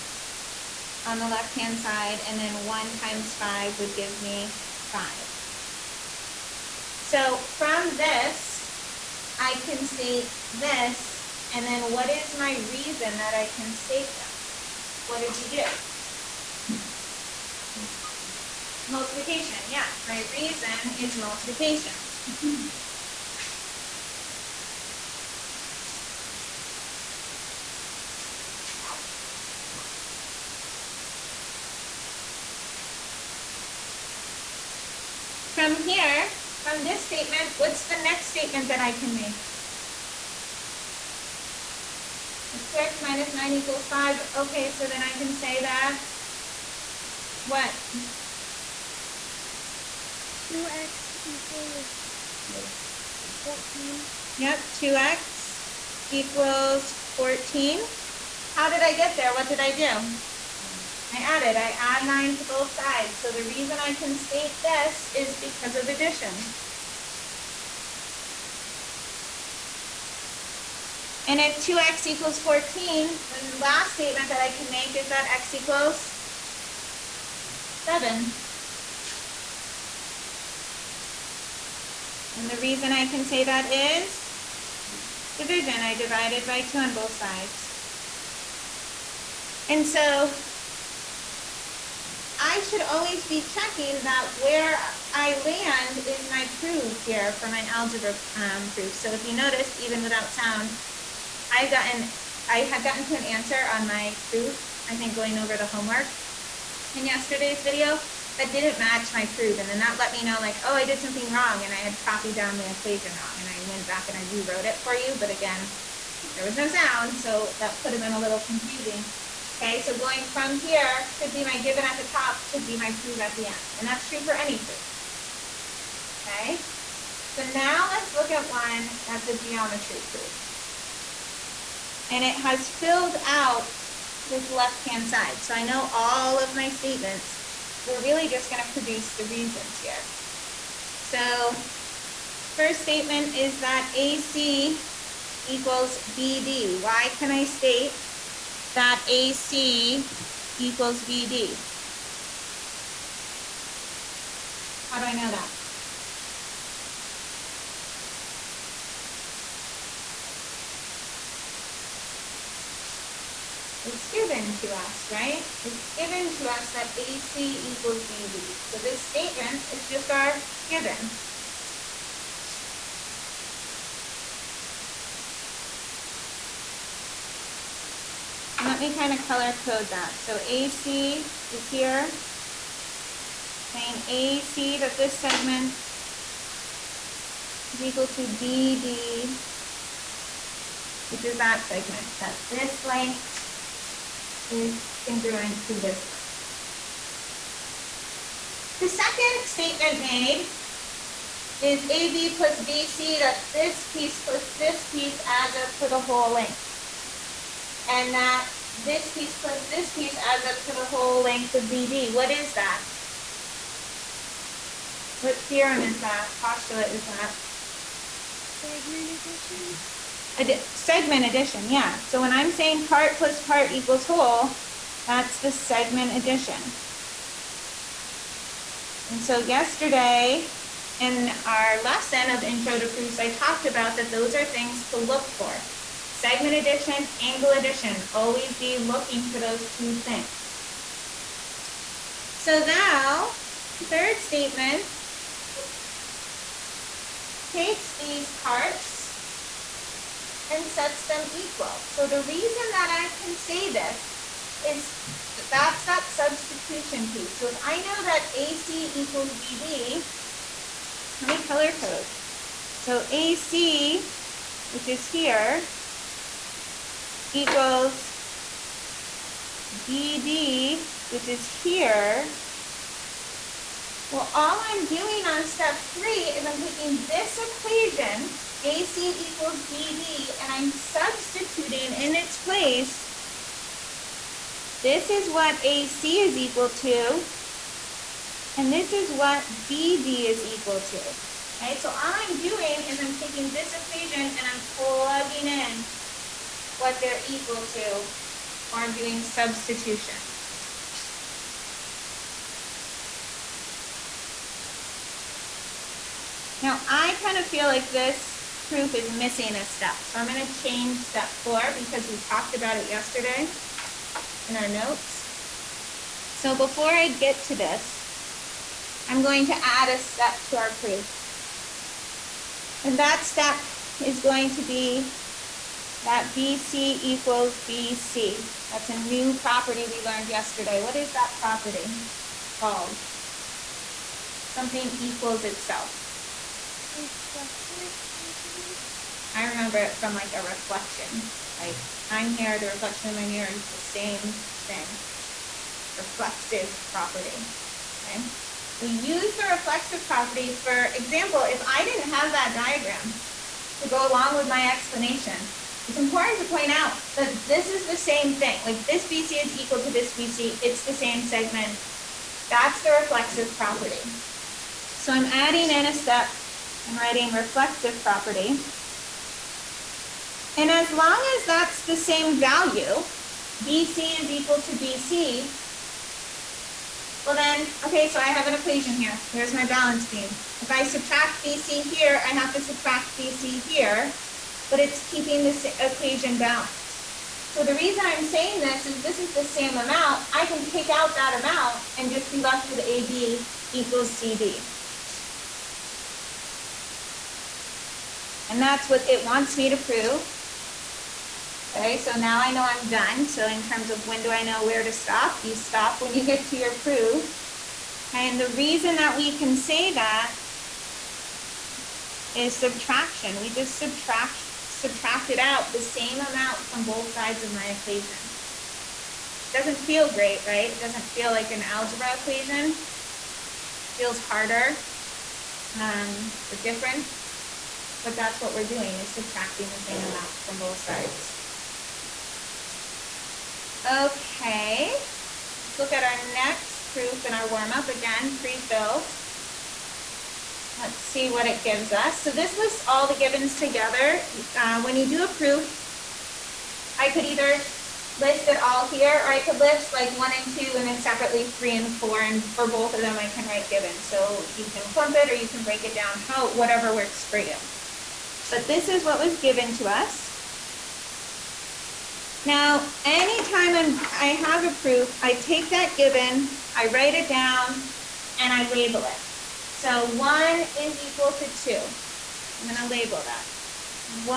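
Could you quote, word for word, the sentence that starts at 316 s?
So before I get to this, I'm going to add a step to our proof.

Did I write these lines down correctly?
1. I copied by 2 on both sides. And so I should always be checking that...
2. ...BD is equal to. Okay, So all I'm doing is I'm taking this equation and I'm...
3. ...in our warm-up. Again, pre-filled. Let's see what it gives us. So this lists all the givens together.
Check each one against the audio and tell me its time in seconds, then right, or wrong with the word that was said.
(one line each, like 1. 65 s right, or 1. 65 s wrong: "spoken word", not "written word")
1. 85 s wrong: "divided", not "copied"
2. 289 s right
3. 437 s right.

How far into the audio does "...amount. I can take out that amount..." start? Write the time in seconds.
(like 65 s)
389 s.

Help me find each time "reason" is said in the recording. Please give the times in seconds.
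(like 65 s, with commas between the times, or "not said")
12 s, 20 s, 63 s, 82 s, 139 s, 252 s, 387 s, 408 s.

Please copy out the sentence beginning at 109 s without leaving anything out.
And then that let me know like, oh, I did something wrong and I had copied down the equation wrong.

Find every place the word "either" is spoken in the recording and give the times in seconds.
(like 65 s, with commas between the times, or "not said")
447 s.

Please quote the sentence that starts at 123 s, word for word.
And that's true for any proof.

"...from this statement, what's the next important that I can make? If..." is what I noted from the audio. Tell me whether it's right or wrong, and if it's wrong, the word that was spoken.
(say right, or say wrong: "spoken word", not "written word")
wrong: "statement", not "important".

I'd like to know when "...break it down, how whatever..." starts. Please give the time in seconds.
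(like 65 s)
455 s.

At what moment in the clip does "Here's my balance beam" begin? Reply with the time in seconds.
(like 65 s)
379 s.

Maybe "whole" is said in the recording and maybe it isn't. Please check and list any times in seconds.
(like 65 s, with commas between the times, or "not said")
205 s, 210 s, 224 s.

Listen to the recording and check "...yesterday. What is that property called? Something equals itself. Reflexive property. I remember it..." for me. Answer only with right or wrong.
right.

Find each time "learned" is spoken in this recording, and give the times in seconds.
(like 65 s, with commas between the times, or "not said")
330 s.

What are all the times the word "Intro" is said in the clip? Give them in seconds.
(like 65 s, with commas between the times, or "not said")
232 s.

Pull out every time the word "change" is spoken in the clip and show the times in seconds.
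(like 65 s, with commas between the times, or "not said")
310 s.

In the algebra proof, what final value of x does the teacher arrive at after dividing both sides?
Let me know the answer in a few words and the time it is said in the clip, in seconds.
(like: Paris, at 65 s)
7, at 75 s.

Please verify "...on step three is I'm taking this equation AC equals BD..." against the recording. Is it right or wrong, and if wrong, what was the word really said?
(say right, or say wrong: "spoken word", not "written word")
right.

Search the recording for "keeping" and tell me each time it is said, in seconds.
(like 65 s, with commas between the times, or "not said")
385 s.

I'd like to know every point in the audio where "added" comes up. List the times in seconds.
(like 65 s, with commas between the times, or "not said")
61 s.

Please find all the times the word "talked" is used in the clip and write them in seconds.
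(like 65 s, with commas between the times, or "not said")
233 s, 312 s.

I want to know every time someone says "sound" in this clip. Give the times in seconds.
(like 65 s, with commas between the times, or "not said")
100 s, 116 s.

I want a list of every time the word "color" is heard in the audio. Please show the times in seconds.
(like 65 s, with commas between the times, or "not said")
179 s, 261 s.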